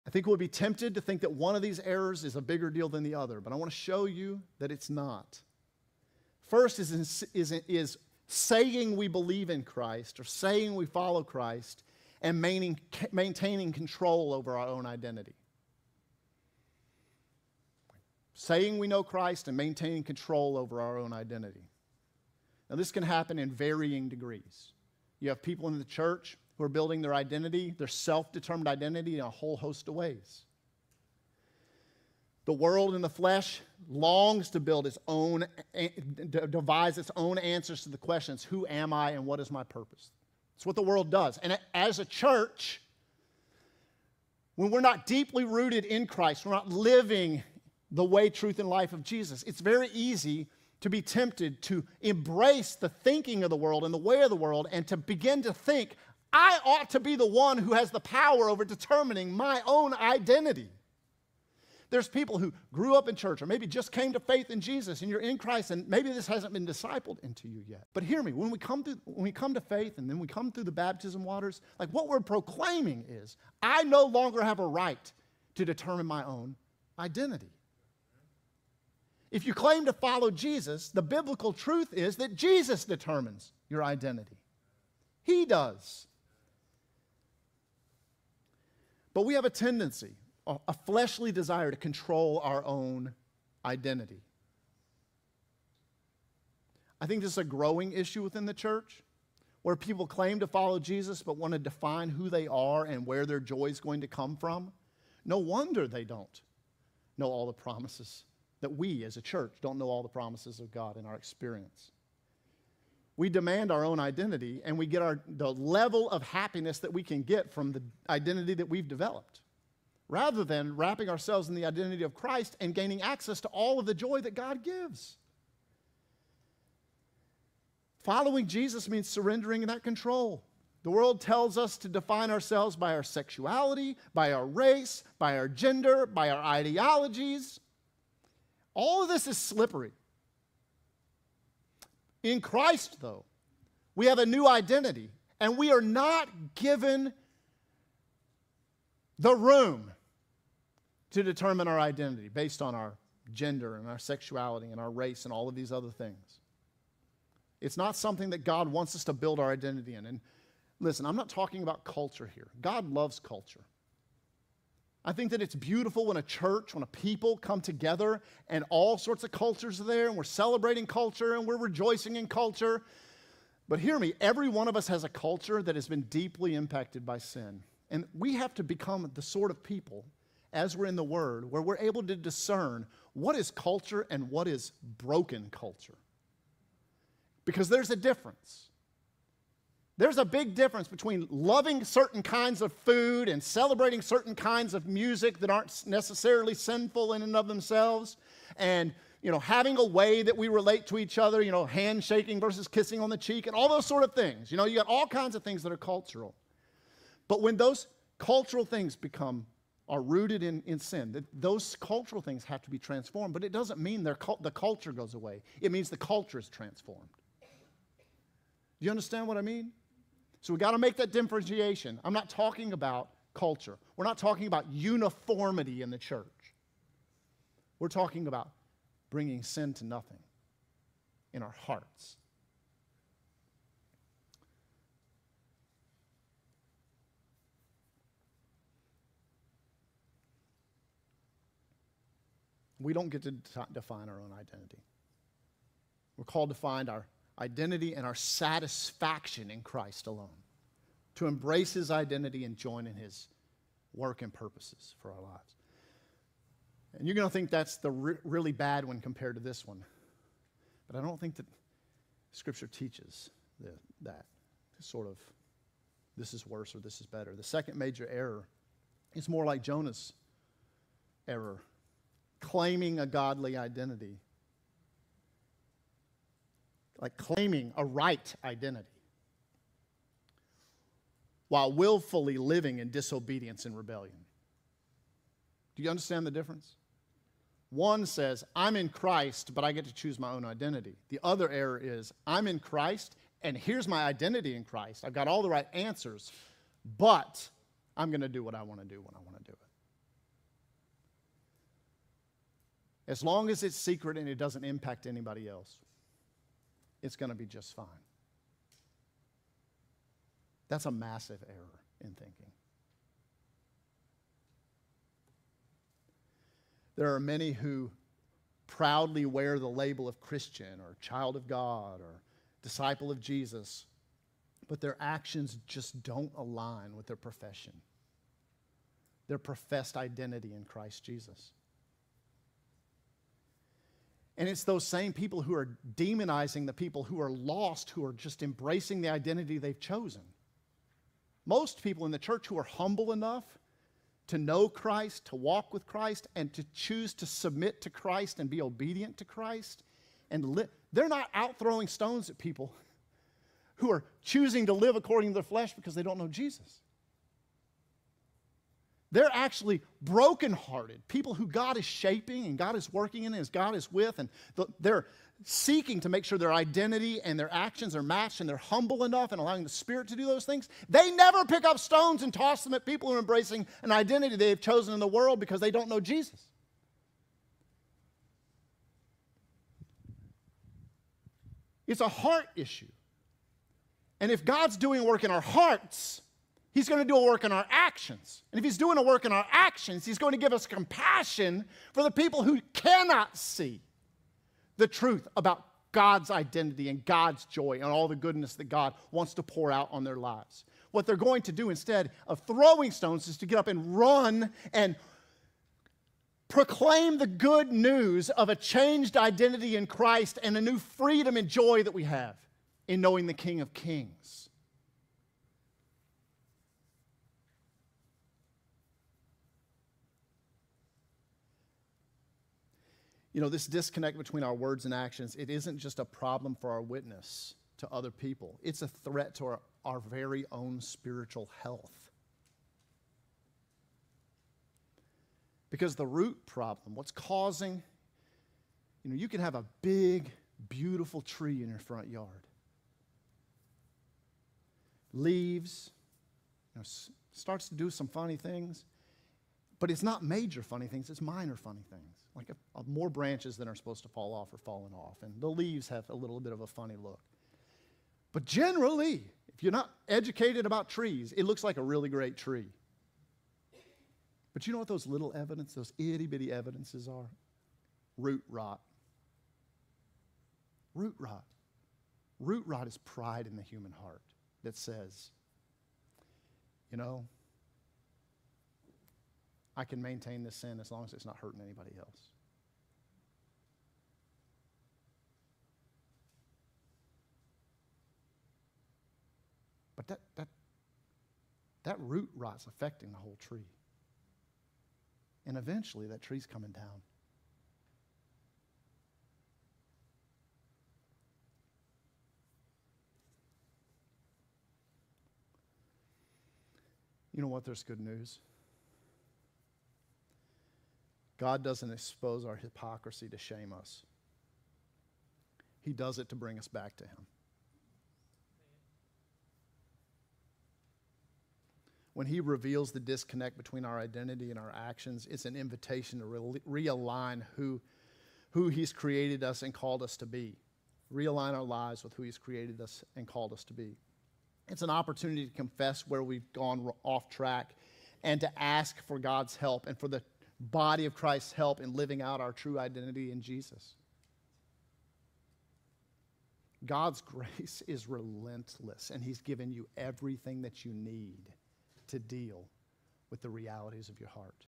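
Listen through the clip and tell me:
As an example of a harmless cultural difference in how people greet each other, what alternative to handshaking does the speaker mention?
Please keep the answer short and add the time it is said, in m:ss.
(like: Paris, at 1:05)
Kissing on the cheek, at 3:22.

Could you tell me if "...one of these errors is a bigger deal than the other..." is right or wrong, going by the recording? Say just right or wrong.
right.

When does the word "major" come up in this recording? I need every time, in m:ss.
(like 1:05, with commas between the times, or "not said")
4:27, 7:30.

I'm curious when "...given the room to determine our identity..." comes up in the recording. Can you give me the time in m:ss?
2:26.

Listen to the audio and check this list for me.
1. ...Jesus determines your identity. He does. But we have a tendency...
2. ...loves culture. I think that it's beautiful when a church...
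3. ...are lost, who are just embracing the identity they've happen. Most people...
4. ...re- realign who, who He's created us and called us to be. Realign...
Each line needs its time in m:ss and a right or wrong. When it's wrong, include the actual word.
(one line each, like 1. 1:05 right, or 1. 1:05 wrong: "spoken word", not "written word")
1. 1:22 right
2. 2:42 right
3. 5:37 wrong: "chosen", not "happen"
4. 8:46 right.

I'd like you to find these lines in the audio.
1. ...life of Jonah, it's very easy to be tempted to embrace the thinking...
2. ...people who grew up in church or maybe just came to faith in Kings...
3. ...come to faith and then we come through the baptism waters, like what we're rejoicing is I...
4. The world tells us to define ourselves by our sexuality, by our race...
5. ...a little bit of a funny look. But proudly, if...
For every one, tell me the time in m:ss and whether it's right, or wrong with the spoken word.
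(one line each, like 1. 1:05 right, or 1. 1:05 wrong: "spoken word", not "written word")
1. 0:48 wrong: "Jesus", not "Jonah"
2. 1:02 wrong: "Jesus", not "Kings"
3. 1:09 wrong: "proclaiming", not "rejoicing"
4. 2:10 right
5. 7:36 wrong: "generally", not "proudly".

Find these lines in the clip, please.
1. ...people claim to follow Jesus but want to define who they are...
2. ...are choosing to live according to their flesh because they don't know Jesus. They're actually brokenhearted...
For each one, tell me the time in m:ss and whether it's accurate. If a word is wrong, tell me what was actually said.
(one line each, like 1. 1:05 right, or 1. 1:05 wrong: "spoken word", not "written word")
1. 1:39 right
2. 5:53 right.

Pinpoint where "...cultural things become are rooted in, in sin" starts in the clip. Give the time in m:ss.
3:28.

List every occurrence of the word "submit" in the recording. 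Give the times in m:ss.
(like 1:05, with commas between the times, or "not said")
5:47.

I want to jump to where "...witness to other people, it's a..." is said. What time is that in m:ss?
7:06.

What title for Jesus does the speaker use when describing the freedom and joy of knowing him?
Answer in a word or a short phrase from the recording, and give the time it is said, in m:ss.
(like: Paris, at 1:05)
King of Kings, at 6:53.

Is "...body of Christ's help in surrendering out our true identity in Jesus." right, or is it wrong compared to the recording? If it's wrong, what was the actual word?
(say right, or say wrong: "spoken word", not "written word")
wrong: "living", not "surrendering".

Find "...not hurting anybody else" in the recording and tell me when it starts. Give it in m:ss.
8:01.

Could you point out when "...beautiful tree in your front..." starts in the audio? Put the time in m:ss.
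7:20.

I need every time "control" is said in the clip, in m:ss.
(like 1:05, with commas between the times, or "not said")
0:13, 0:20, 1:31, 2:09.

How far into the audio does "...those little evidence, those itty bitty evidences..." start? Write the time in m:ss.
7:44.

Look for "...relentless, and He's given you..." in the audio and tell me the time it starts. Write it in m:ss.
9:08.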